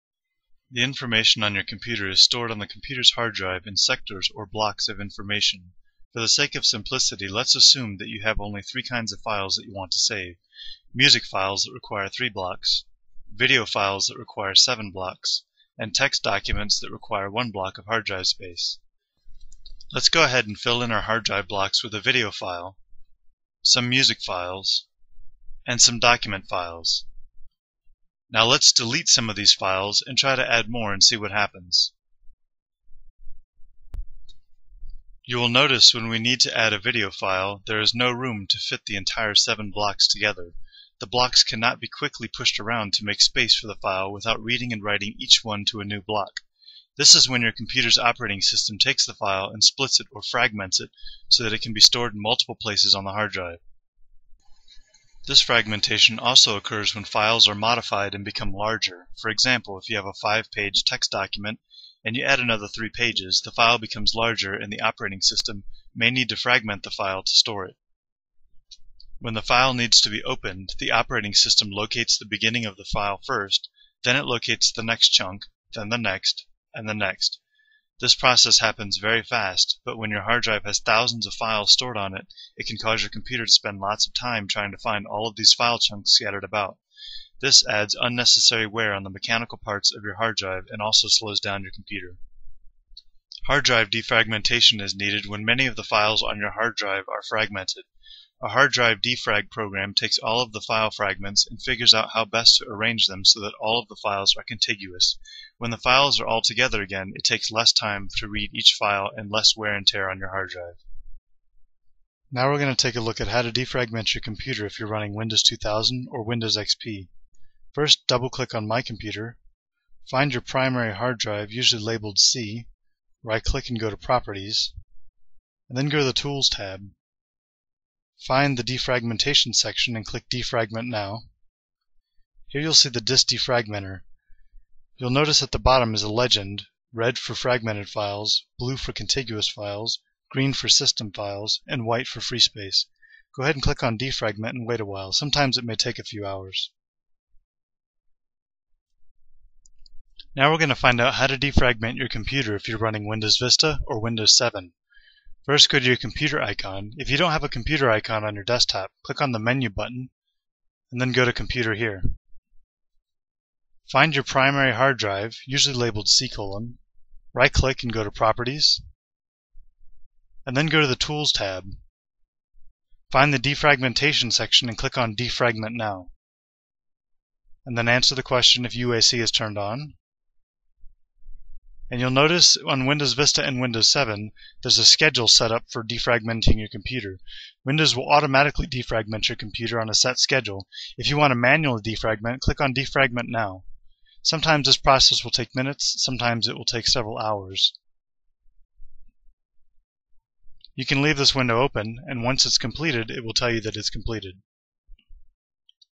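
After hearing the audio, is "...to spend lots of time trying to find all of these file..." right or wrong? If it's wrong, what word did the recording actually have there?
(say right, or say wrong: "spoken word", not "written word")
right.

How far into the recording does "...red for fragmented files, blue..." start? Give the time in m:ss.
2:16.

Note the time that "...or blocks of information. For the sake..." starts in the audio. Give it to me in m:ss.
0:04.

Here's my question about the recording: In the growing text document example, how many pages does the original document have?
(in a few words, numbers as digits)
5.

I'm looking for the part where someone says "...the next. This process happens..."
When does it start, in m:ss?
1:16.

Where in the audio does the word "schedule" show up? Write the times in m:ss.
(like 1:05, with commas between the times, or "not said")
3:04, 3:10.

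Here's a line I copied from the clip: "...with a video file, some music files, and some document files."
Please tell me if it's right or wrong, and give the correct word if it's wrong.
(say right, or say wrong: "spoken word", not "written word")
right.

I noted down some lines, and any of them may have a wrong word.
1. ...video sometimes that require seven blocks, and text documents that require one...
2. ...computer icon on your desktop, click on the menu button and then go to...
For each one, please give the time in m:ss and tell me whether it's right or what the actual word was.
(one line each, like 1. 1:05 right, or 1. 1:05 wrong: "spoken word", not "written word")
1. 0:13 wrong: "files", not "sometimes"
2. 2:37 right.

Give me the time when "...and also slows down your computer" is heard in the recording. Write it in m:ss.
1:30.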